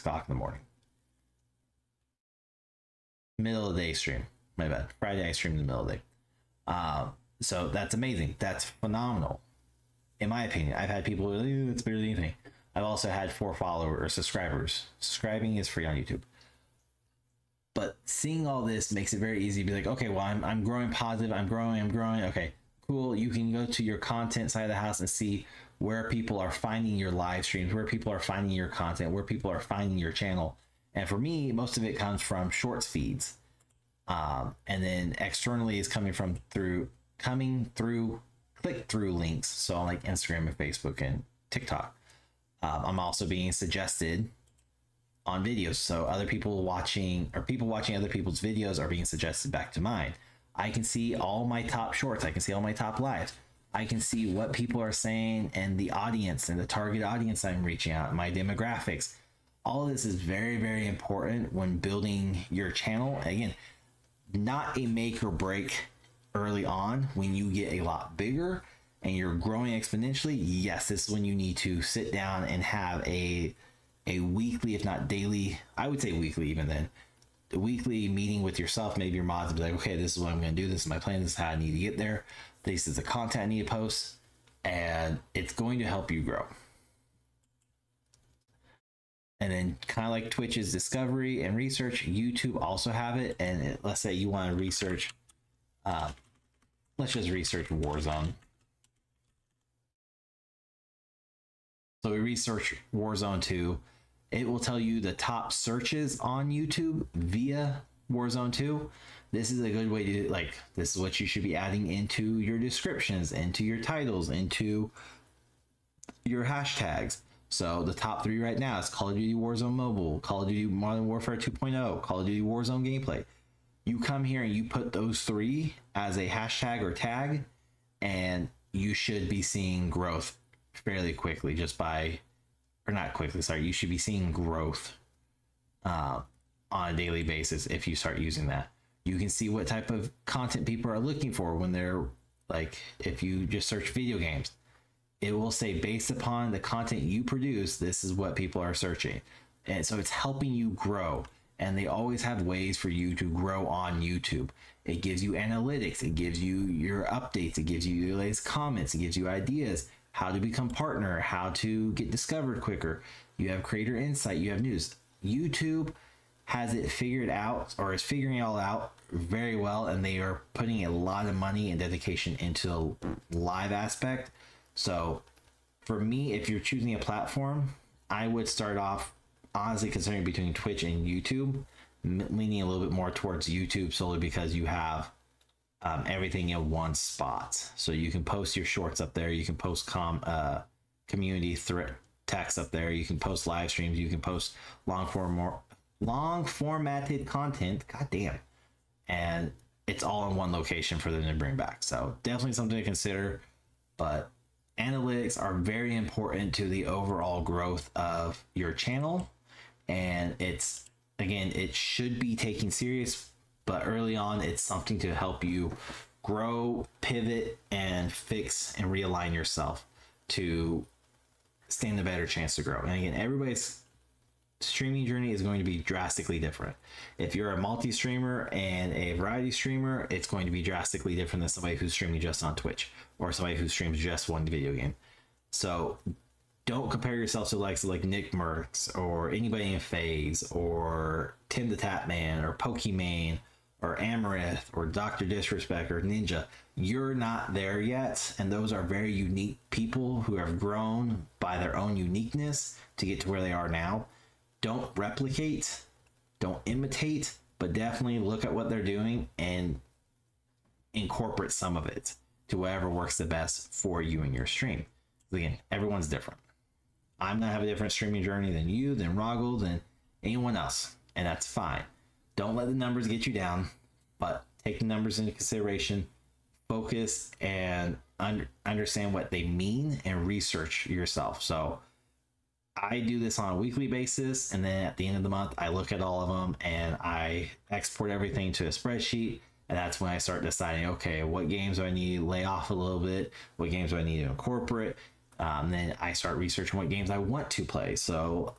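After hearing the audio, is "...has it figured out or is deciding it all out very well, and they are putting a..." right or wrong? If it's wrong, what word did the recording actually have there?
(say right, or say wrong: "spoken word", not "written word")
wrong: "figuring", not "deciding".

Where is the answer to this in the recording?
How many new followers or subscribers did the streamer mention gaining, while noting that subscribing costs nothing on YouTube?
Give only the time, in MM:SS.
00:13.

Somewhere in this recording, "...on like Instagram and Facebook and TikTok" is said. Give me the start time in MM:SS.
00:39.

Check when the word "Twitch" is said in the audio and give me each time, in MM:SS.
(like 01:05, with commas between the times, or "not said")
01:30, 03:00, 03:52.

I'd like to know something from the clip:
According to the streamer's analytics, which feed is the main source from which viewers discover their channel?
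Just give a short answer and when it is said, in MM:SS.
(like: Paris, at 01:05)
Shorts feeds, at 00:32.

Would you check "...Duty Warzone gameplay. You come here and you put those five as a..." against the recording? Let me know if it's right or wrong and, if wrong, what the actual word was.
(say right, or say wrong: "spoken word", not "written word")
wrong: "three", not "five".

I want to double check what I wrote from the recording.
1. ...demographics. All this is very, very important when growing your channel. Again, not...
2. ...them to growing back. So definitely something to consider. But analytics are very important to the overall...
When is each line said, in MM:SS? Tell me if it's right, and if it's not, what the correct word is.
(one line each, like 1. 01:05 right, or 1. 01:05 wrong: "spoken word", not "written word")
1. 00:58 wrong: "building", not "growing"
2. 03:21 wrong: "bring", not "growing".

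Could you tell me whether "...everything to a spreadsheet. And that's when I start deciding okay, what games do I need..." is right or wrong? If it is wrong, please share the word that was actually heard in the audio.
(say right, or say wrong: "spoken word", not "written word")
right.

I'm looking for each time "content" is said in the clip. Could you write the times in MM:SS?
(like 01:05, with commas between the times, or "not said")
00:23, 00:28, 01:23, 02:20, 02:26, 03:17.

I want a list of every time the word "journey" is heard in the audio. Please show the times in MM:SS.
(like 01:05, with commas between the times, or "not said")
03:45, 04:28.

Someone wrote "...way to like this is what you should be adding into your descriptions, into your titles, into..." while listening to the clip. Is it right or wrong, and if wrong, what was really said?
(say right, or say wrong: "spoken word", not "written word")
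right.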